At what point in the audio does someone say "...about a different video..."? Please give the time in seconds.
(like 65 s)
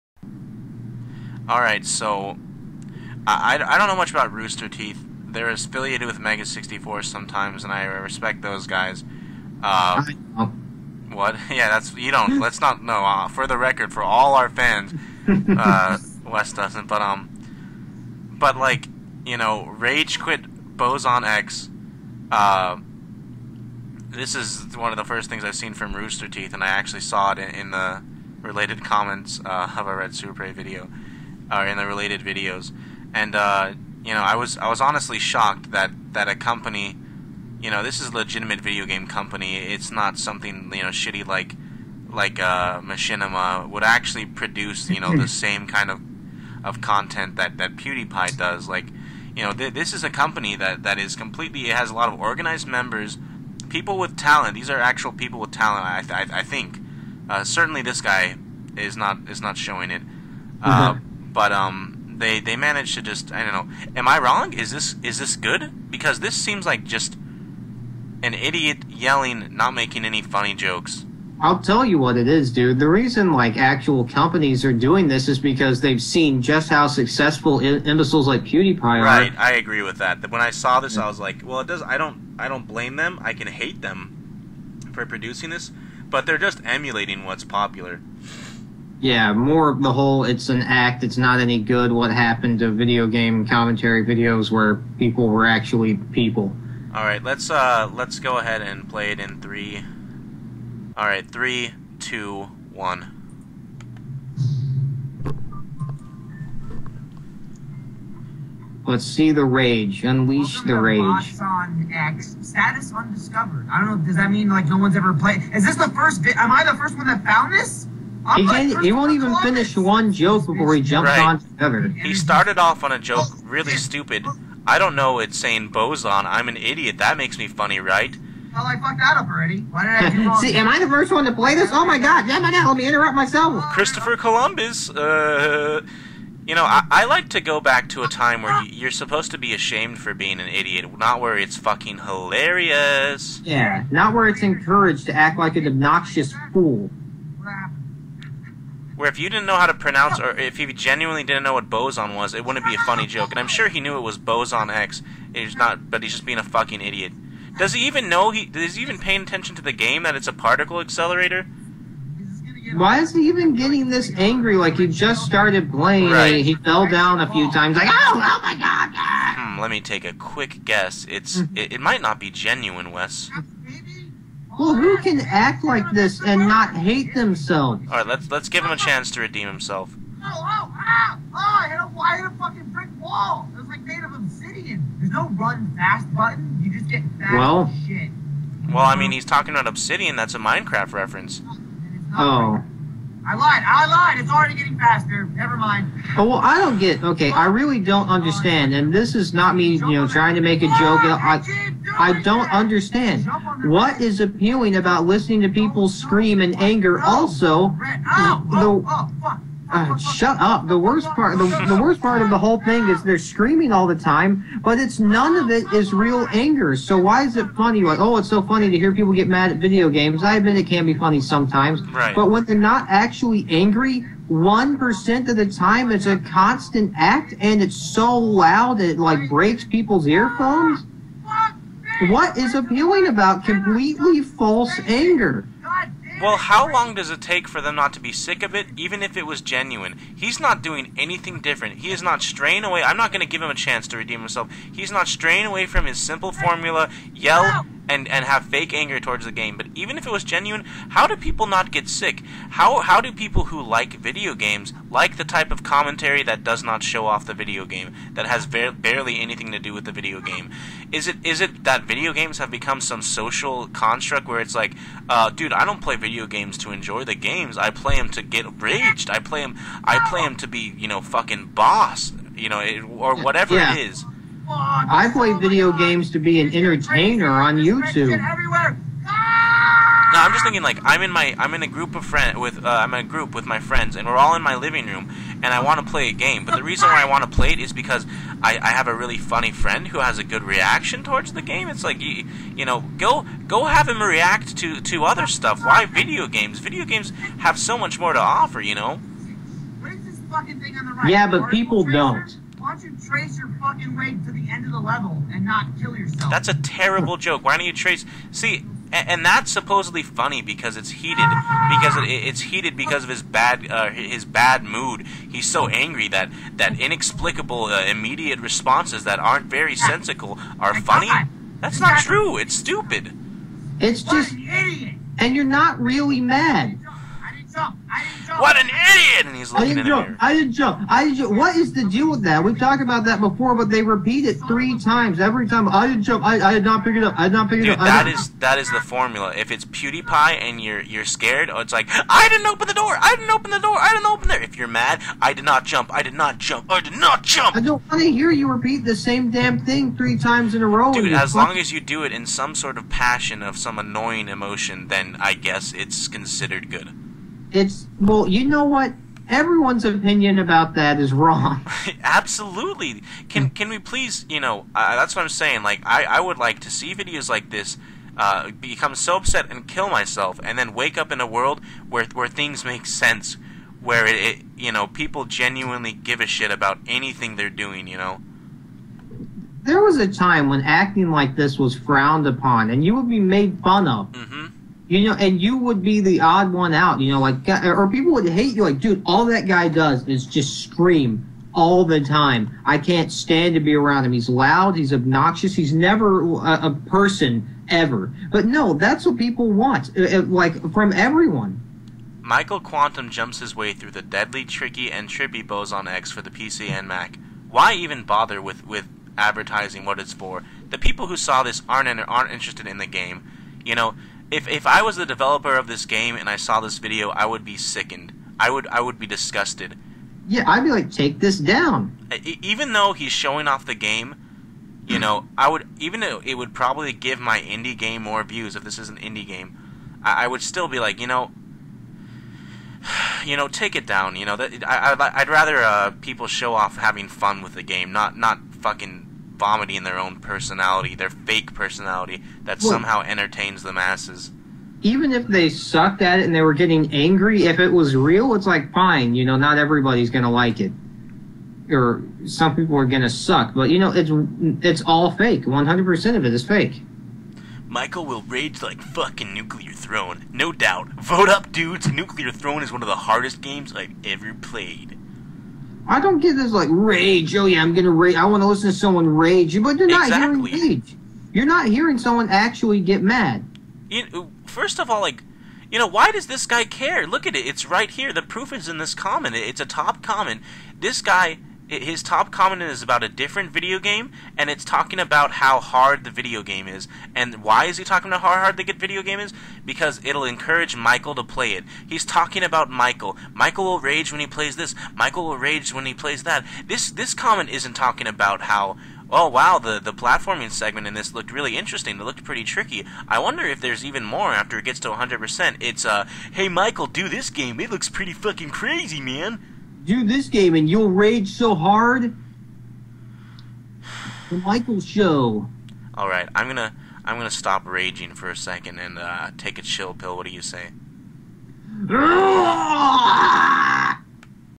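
482 s.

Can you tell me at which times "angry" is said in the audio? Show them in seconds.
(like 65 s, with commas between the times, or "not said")
164 s, 223 s, 315 s, 446 s.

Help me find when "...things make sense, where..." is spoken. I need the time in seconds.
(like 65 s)
372 s.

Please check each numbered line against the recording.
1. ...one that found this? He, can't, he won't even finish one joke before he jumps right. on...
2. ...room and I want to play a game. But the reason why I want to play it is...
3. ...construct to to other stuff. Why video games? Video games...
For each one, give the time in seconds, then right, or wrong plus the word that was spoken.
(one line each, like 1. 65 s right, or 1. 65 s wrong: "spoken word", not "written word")
1. 116 s right
2. 284 s right
3. 294 s wrong: "react", not "construct".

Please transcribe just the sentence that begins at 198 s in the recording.
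And this is not me, you know, trying to make a joke.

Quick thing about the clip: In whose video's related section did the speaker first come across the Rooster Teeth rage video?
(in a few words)
Retsupurae.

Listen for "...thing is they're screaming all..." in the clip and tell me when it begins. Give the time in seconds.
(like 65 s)
212 s.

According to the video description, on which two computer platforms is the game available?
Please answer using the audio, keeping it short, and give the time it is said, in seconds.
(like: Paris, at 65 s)
PC and Mac, at 406 s.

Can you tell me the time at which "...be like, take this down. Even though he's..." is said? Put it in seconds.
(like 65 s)
420 s.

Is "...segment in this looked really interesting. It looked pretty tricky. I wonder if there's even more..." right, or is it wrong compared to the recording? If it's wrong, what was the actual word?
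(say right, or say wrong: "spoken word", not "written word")
right.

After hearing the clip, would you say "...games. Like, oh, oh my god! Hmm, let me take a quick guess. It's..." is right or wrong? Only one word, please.
wrong.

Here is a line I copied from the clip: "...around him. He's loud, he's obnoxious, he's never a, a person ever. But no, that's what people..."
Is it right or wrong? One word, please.
right.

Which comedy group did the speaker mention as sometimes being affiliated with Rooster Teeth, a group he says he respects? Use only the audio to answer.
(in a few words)
Mega 64.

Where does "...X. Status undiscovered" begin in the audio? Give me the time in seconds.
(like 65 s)
111 s.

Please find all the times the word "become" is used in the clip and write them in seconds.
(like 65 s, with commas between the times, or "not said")
262 s, 368 s.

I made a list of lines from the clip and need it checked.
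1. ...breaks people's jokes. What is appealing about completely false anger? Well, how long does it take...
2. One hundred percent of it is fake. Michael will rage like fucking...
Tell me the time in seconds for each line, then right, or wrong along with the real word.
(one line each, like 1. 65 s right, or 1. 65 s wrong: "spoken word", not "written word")
1. 229 s wrong: "earphones", not "jokes"
2. 455 s right.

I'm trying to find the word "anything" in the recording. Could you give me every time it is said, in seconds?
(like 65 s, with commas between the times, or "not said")
240 s, 259 s, 376 s.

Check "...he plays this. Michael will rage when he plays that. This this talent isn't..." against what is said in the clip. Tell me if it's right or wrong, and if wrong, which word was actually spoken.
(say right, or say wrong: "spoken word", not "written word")
wrong: "comment", not "talent".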